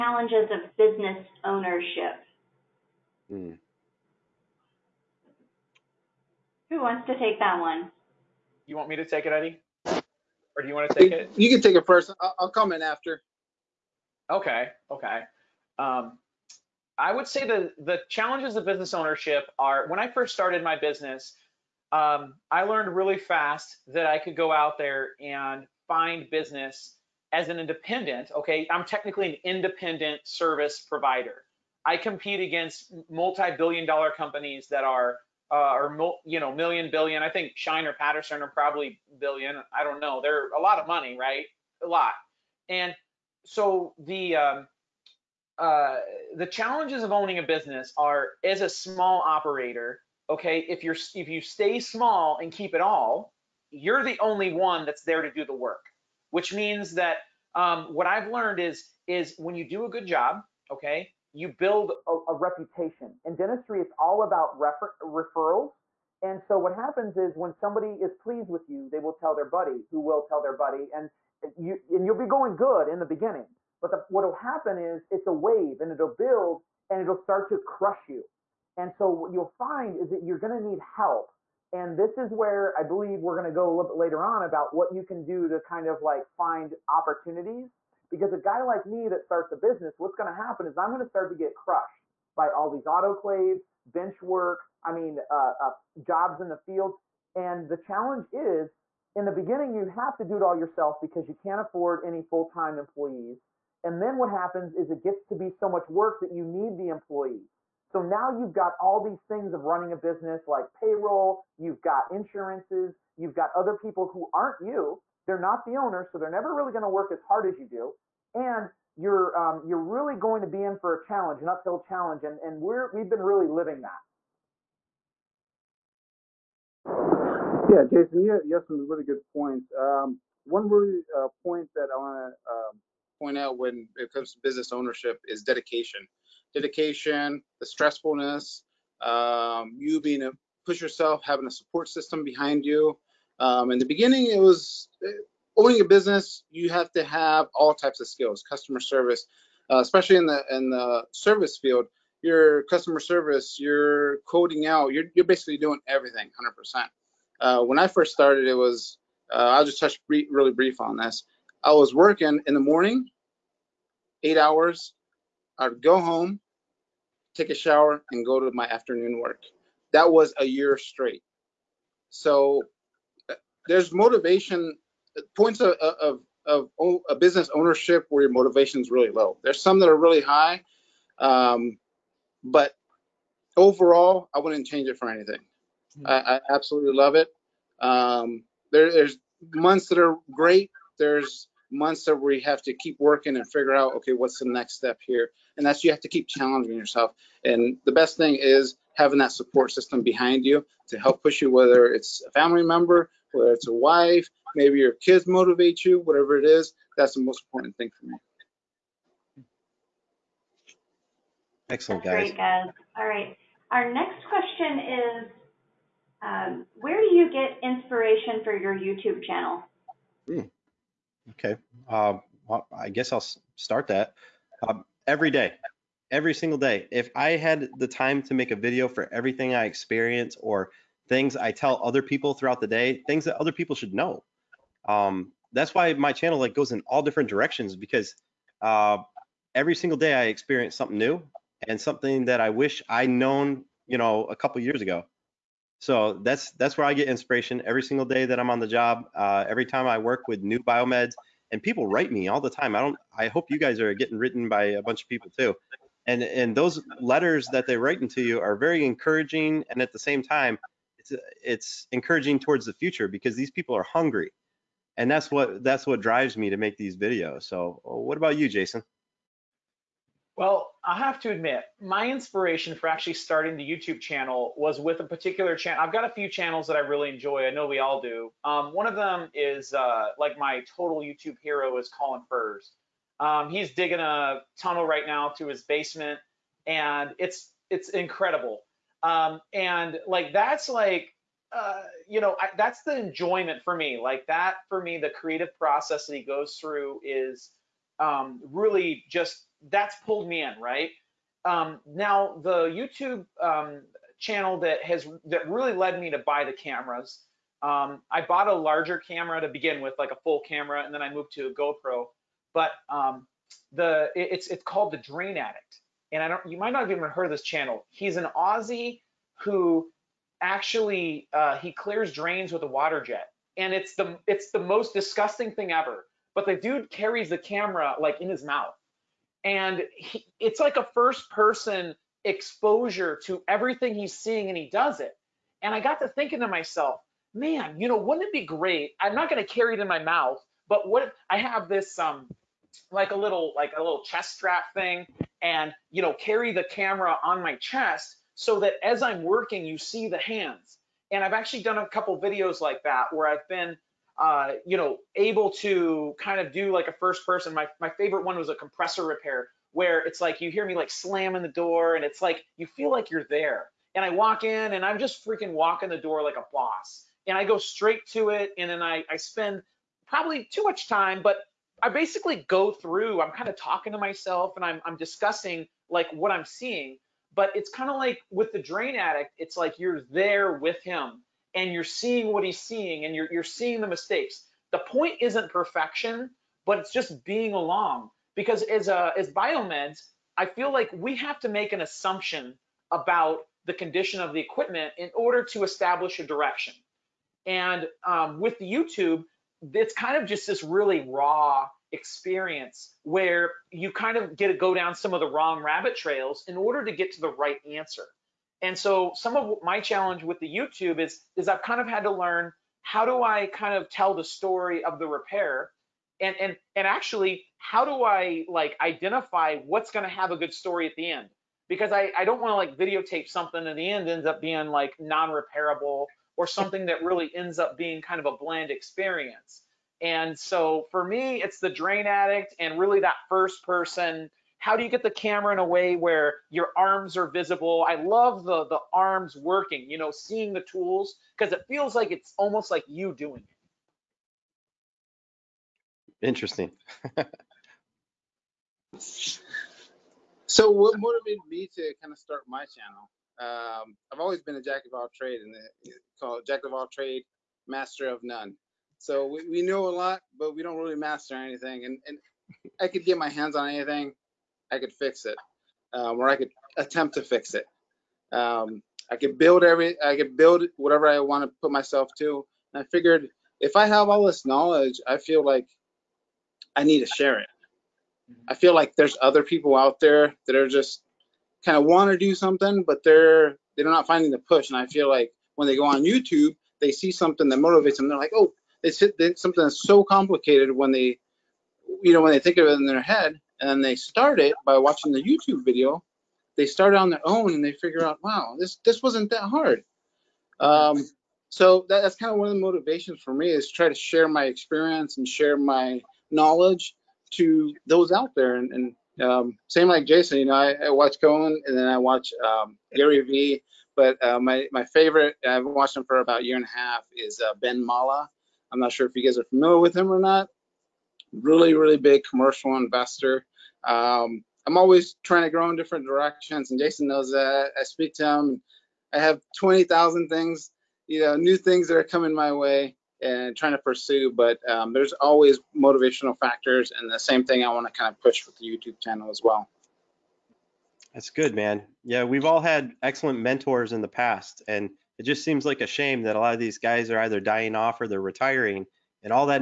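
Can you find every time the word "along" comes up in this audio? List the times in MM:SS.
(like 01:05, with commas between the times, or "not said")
06:27.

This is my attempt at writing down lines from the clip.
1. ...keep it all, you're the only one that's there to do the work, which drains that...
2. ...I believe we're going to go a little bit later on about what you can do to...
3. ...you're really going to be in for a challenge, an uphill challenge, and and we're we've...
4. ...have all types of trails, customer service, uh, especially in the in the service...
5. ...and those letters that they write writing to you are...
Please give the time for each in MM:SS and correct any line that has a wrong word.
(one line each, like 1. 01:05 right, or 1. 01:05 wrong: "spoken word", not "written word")
1. 00:52 wrong: "means", not "drains"
2. 01:22 right
3. 01:59 right
4. 02:27 wrong: "skills", not "trails"
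5. 04:16 right.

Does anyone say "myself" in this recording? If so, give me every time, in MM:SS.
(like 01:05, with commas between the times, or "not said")
05:36, 06:13, 07:51.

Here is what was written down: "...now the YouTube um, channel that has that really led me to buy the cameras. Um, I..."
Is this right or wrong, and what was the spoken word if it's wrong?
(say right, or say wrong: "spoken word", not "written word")
right.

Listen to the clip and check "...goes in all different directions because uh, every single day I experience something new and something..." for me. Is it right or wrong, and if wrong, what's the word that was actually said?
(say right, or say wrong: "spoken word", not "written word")
right.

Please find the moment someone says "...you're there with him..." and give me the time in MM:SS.
06:19.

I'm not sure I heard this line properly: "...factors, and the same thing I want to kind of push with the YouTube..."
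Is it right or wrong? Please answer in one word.
right.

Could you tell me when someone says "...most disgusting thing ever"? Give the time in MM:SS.
05:24.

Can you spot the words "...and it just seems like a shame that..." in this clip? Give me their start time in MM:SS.
09:04.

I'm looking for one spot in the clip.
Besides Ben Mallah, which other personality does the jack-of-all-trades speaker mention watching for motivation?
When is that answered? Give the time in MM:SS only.
08:32.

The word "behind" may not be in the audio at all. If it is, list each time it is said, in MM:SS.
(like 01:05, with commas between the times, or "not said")
02:22, 03:20.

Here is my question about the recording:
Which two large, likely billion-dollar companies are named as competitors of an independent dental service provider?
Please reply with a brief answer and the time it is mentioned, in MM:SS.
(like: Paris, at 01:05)
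Schein or Patterson, at 00:37.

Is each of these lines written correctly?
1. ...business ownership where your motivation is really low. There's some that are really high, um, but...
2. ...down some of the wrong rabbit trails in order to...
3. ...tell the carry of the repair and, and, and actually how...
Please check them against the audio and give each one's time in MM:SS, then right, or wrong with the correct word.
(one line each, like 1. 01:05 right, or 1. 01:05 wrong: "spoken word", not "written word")
1. 02:57 right
2. 06:44 right
3. 06:53 wrong: "story", not "carry".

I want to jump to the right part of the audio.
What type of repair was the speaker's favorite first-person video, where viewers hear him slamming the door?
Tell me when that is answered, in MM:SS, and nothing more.
05:58.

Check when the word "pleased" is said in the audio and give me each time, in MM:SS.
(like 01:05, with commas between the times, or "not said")
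01:08.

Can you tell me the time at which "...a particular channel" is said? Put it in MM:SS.
04:34.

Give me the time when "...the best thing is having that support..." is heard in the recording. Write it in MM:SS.
03:17.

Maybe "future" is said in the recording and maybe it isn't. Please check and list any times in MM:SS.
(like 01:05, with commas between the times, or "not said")
04:22.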